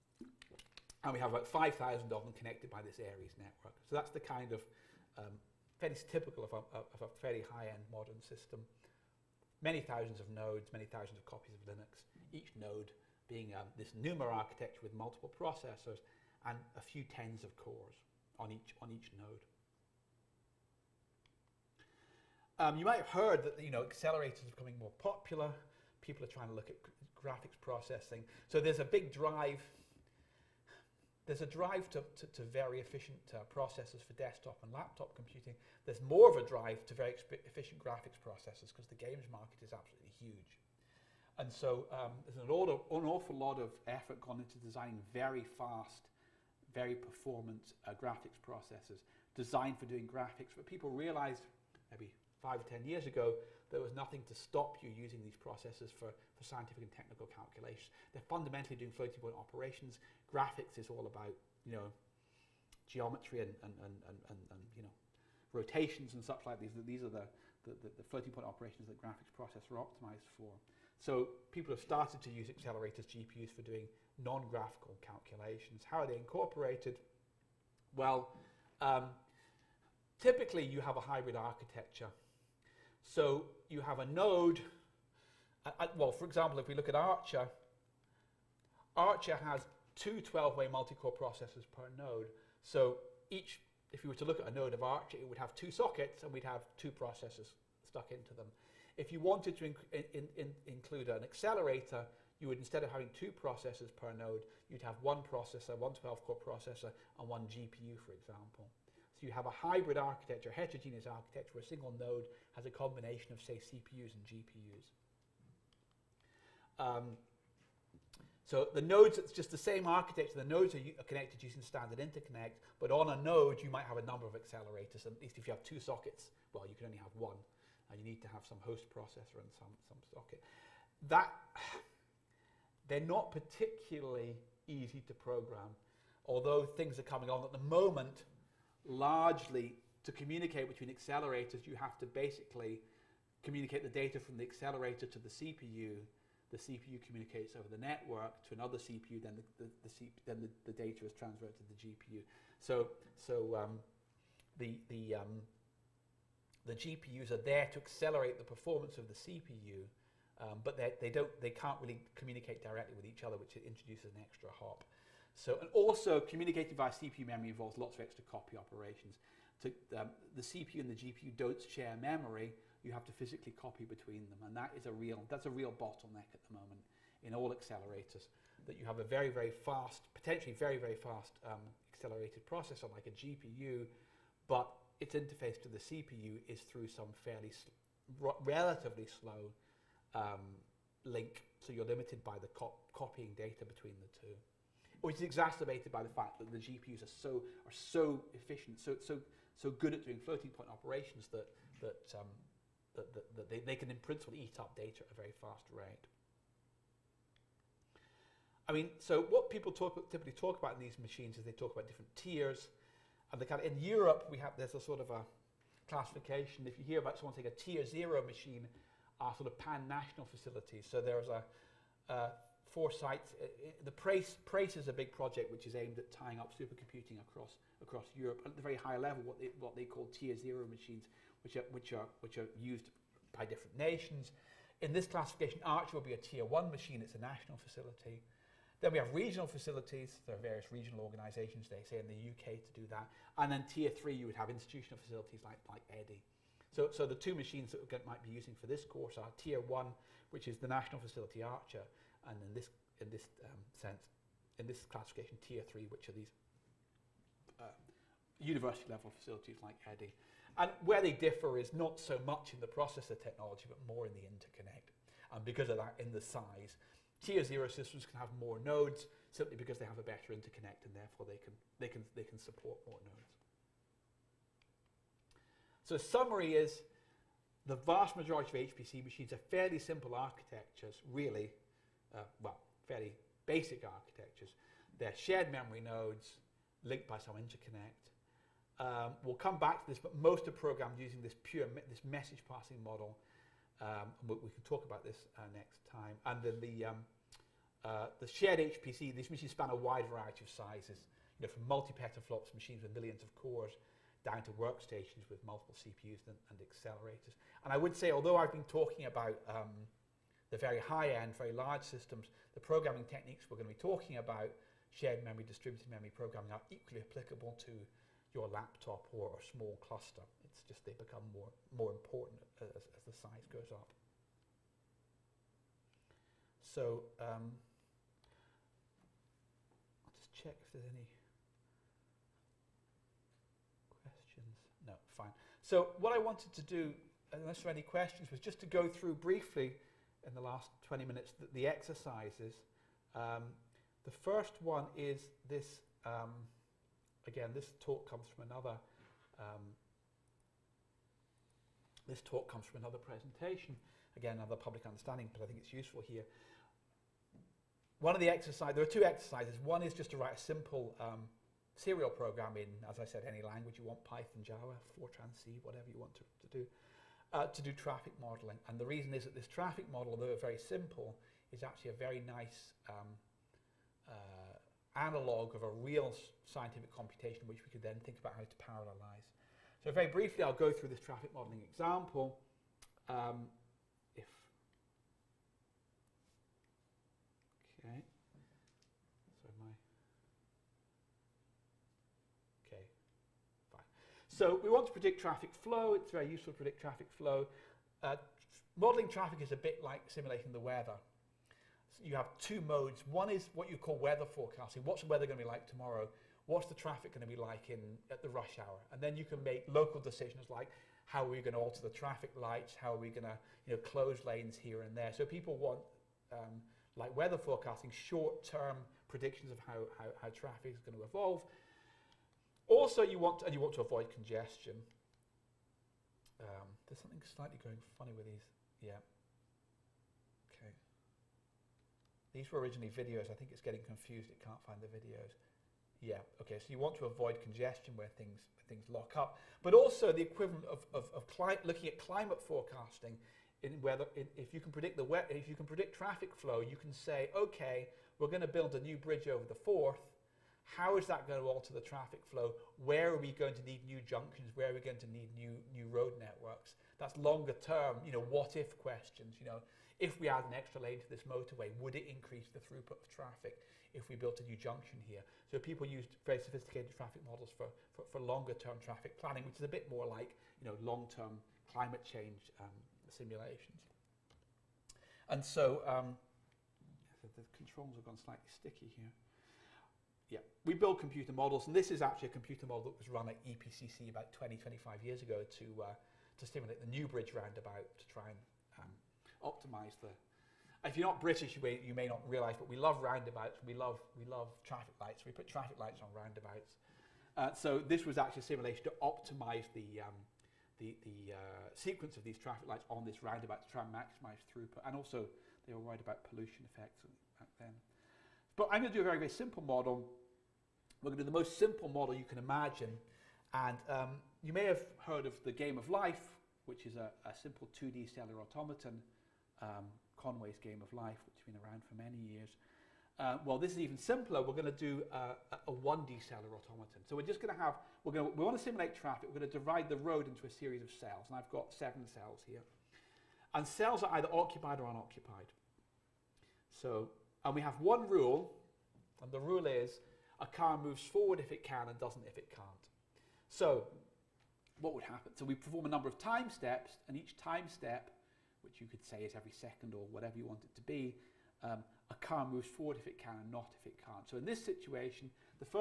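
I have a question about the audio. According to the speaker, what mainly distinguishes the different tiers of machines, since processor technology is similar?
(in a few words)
The interconnect.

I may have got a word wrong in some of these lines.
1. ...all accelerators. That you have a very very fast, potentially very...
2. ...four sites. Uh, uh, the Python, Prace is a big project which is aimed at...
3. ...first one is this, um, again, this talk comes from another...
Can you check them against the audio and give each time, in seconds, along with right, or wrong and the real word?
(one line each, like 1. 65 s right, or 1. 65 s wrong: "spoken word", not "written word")
1. 177 s right
2. 222 s wrong: "Prace", not "Python"
3. 344 s right.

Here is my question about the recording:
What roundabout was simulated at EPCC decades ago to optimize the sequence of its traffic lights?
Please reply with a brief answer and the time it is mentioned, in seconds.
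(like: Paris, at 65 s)
Newbridge roundabout, at 486 s.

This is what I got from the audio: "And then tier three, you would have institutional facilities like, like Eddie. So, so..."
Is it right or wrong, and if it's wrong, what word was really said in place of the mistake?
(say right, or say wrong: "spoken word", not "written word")
right.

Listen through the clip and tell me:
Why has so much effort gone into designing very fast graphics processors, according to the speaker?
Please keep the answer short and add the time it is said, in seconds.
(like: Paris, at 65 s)
The games market, at 38 s.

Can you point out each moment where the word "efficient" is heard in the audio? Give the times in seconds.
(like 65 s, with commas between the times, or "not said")
32 s, 37 s, 198 s.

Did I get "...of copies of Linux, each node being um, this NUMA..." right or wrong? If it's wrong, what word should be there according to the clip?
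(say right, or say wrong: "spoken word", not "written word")
right.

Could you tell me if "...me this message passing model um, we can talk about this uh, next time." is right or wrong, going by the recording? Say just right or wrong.
right.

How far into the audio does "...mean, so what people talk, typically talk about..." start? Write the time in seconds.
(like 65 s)
208 s.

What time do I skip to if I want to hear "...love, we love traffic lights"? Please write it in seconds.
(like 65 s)
493 s.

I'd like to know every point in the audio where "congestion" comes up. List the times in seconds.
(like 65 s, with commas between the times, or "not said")
424 s, 437 s.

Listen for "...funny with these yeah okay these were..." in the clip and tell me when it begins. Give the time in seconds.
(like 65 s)
427 s.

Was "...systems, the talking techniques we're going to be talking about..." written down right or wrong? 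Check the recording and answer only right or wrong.
wrong.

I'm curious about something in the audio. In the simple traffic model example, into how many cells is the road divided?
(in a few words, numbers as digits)
7.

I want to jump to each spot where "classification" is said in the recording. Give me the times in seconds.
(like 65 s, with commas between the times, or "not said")
215 s, 235 s, 254 s.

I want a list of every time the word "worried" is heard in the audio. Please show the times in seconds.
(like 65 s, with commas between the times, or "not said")
505 s.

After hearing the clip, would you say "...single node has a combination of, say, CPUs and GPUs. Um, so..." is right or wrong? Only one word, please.
right.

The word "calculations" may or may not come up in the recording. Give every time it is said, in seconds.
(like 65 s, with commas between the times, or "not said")
57 s, 75 s.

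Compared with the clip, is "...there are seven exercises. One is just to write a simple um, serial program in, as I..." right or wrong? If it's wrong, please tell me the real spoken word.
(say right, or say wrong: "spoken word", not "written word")
wrong: "two", not "seven".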